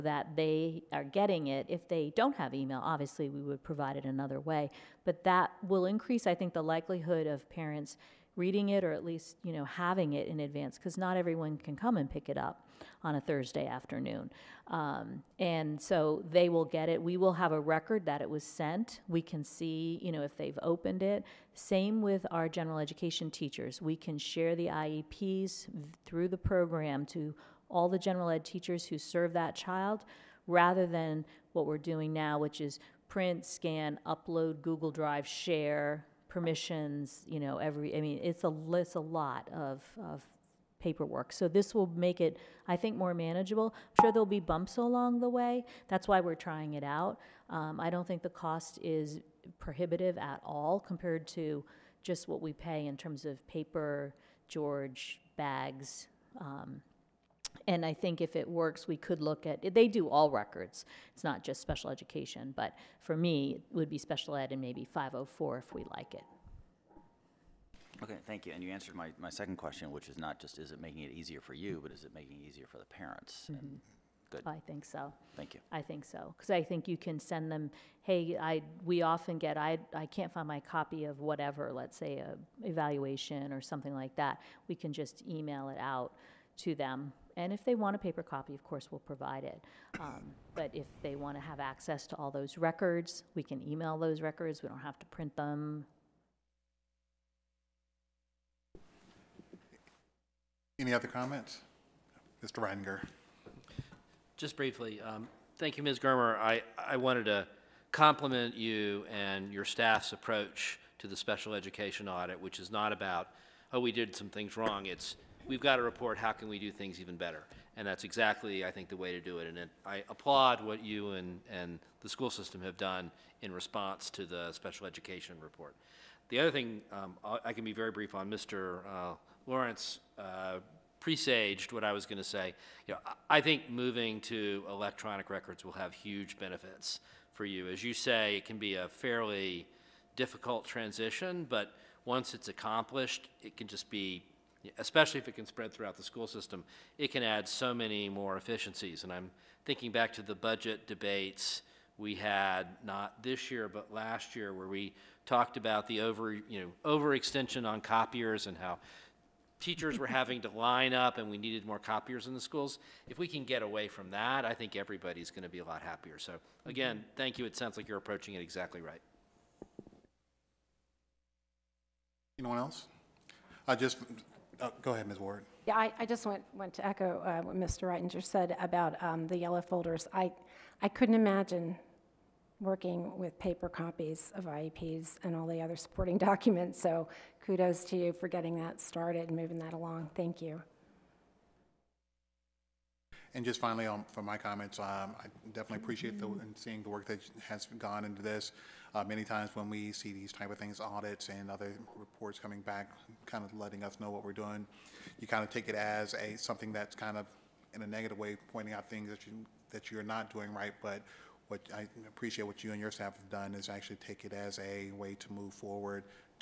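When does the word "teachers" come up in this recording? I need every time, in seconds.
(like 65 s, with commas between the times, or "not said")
23 s, 28 s, 159 s.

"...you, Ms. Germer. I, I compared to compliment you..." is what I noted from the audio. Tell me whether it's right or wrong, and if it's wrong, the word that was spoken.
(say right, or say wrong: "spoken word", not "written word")
wrong: "wanted", not "compared".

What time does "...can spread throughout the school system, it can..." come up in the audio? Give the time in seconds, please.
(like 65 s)
145 s.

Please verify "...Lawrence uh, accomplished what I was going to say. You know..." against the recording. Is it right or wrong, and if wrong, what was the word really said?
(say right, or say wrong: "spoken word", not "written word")
wrong: "presaged", not "accomplished".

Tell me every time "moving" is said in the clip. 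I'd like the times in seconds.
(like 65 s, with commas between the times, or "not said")
133 s, 189 s.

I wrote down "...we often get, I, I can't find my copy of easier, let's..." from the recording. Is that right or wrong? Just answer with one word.
wrong.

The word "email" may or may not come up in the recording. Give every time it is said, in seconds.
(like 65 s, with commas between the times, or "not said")
2 s, 85 s, 93 s.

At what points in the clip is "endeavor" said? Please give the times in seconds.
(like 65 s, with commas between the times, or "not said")
not said.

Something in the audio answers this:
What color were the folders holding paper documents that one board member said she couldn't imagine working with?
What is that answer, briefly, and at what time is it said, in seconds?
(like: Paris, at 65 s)
Yellow, at 179 s.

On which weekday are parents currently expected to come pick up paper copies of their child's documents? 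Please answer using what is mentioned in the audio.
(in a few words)
Thursday.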